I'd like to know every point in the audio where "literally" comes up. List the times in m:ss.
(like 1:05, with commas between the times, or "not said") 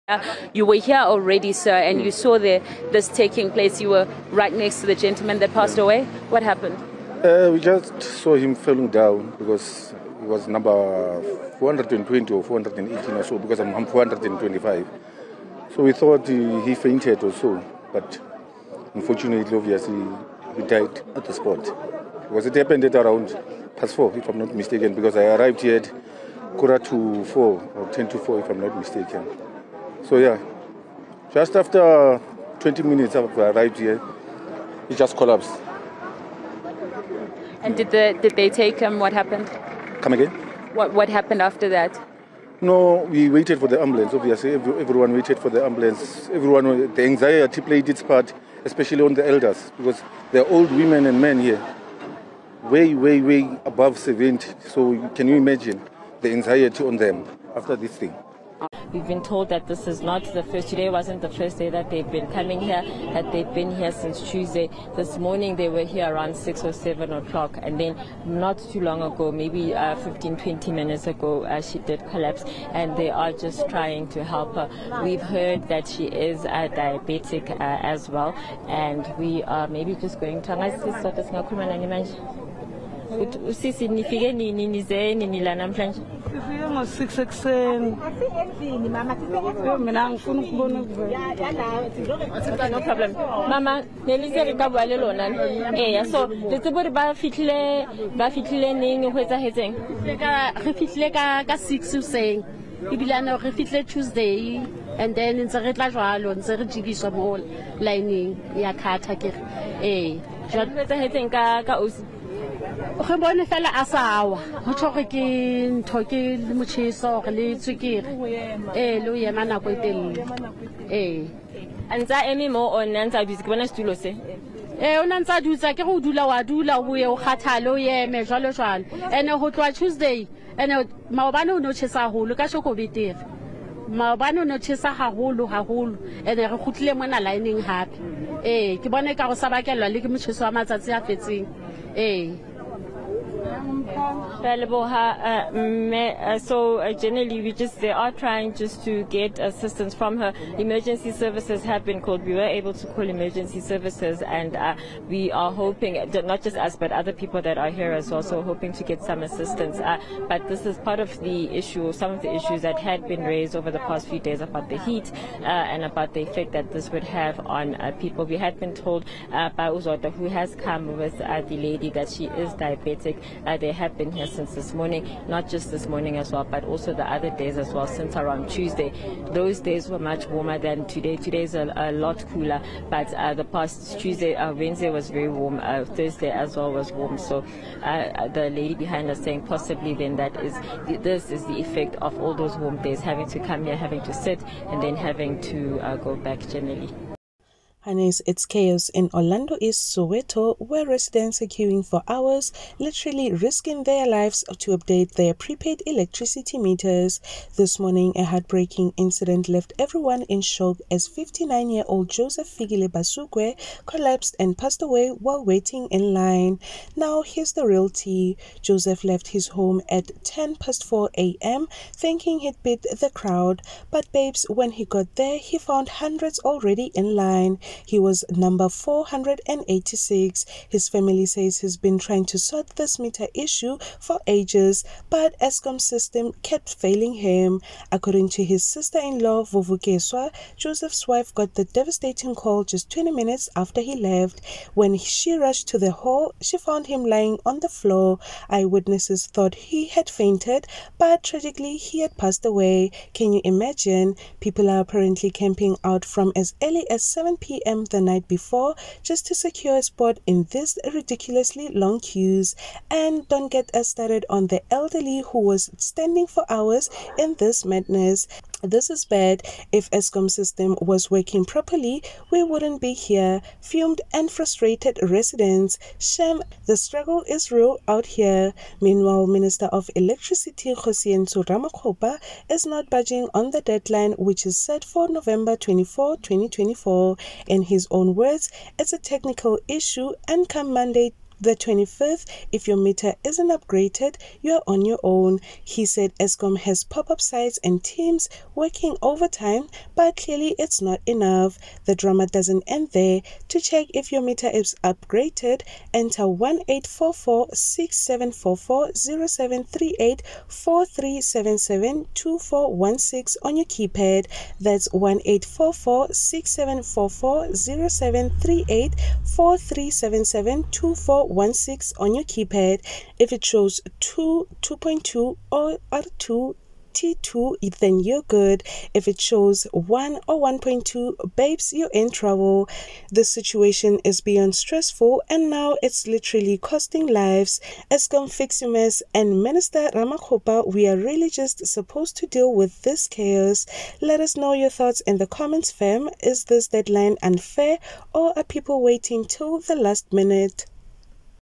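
3:22, 5:36.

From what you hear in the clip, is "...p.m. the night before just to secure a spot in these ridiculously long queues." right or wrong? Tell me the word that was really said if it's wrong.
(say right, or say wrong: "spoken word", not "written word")
right.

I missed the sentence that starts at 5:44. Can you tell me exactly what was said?
Let us know your thoughts in the comments, fam.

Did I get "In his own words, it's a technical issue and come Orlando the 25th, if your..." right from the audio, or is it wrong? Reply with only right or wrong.
wrong.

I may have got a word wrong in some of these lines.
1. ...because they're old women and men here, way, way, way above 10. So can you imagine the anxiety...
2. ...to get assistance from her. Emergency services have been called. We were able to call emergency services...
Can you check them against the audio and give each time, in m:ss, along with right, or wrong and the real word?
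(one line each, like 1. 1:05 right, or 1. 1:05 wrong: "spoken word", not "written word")
1. 0:49 wrong: "70", not "10"
2. 2:28 right.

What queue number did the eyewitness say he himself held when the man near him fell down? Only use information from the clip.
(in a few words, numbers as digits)
425.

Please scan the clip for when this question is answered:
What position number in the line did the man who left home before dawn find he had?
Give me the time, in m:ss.
3:48.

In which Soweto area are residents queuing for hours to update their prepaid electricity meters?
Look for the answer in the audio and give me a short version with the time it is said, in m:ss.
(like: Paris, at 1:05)
Orlando East, at 3:19.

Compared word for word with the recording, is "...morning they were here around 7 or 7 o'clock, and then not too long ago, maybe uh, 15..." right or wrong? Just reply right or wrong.
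wrong.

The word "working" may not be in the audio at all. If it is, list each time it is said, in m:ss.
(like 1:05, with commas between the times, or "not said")
4:31, 4:58.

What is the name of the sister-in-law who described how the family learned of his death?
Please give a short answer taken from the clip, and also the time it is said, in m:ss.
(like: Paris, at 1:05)
Vuvukeswa, at 3:59.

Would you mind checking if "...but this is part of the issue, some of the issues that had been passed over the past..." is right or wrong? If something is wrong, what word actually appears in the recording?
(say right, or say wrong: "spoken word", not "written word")
wrong: "raised", not "passed".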